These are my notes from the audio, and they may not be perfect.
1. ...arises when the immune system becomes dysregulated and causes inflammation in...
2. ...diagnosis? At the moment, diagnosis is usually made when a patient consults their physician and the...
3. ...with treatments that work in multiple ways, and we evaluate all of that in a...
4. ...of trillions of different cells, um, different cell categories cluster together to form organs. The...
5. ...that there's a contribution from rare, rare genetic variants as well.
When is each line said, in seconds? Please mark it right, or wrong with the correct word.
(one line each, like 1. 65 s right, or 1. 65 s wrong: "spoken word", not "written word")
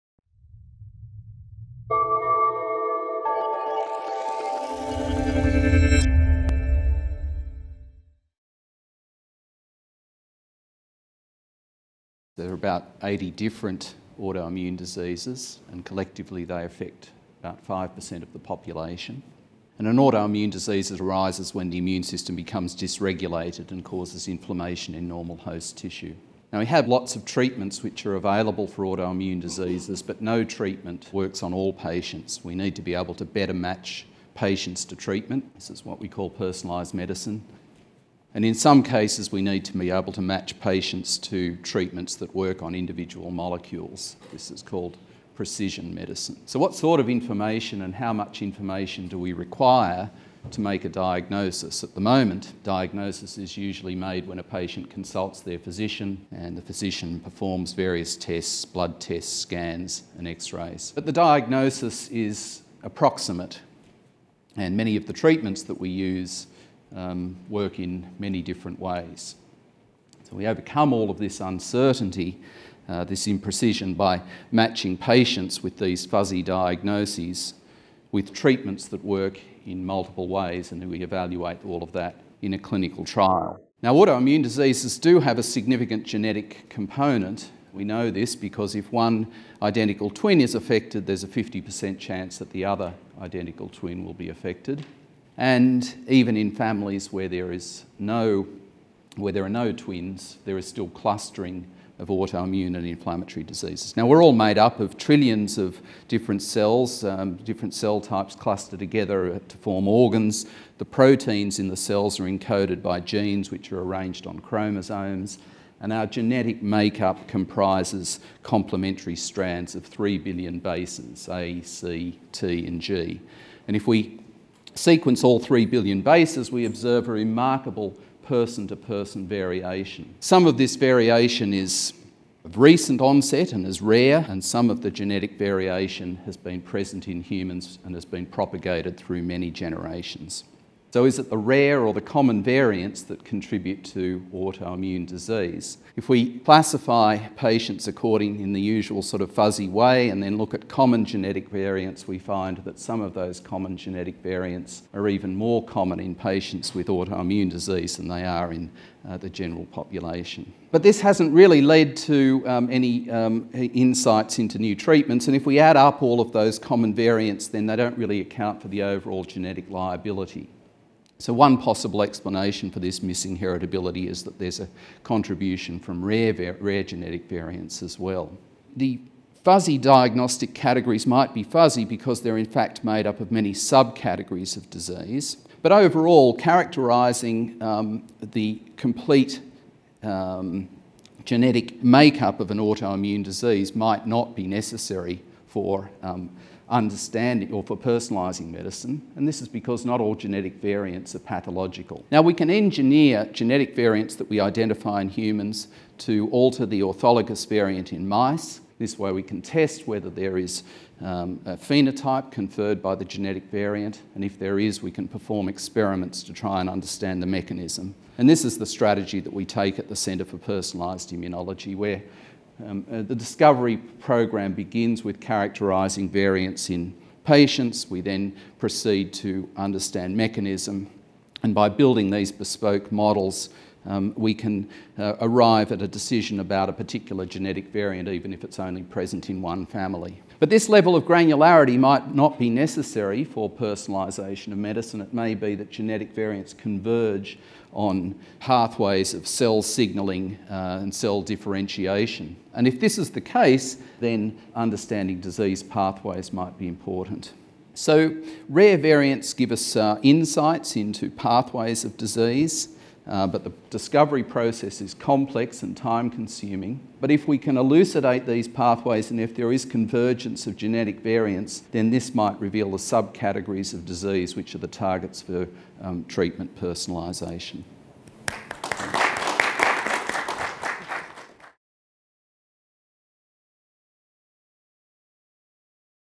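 1. 20 s right
2. 50 s right
3. 78 s right
4. 104 s wrong: "types", not "categories"
5. 174 s right.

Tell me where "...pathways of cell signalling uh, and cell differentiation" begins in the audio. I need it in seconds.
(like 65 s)
248 s.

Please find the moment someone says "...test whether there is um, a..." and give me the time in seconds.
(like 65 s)
209 s.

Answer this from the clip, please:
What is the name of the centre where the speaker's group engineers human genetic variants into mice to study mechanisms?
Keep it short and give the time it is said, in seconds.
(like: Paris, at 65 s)
Centre for Personalised Immunology, at 219 s.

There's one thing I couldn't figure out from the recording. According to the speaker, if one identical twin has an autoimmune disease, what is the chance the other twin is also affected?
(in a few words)
50%.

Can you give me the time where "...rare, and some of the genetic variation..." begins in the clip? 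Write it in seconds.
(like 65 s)
133 s.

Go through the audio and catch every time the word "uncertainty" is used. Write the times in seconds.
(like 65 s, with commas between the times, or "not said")
71 s.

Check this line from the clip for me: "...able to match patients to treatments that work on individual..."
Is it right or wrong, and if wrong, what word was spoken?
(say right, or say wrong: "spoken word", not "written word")
right.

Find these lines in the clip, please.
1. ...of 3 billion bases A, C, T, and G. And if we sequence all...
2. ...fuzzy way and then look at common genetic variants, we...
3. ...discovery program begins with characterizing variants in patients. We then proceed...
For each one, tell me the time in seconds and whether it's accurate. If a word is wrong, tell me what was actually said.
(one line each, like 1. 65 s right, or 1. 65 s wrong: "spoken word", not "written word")
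1. 119 s right
2. 149 s right
3. 223 s right.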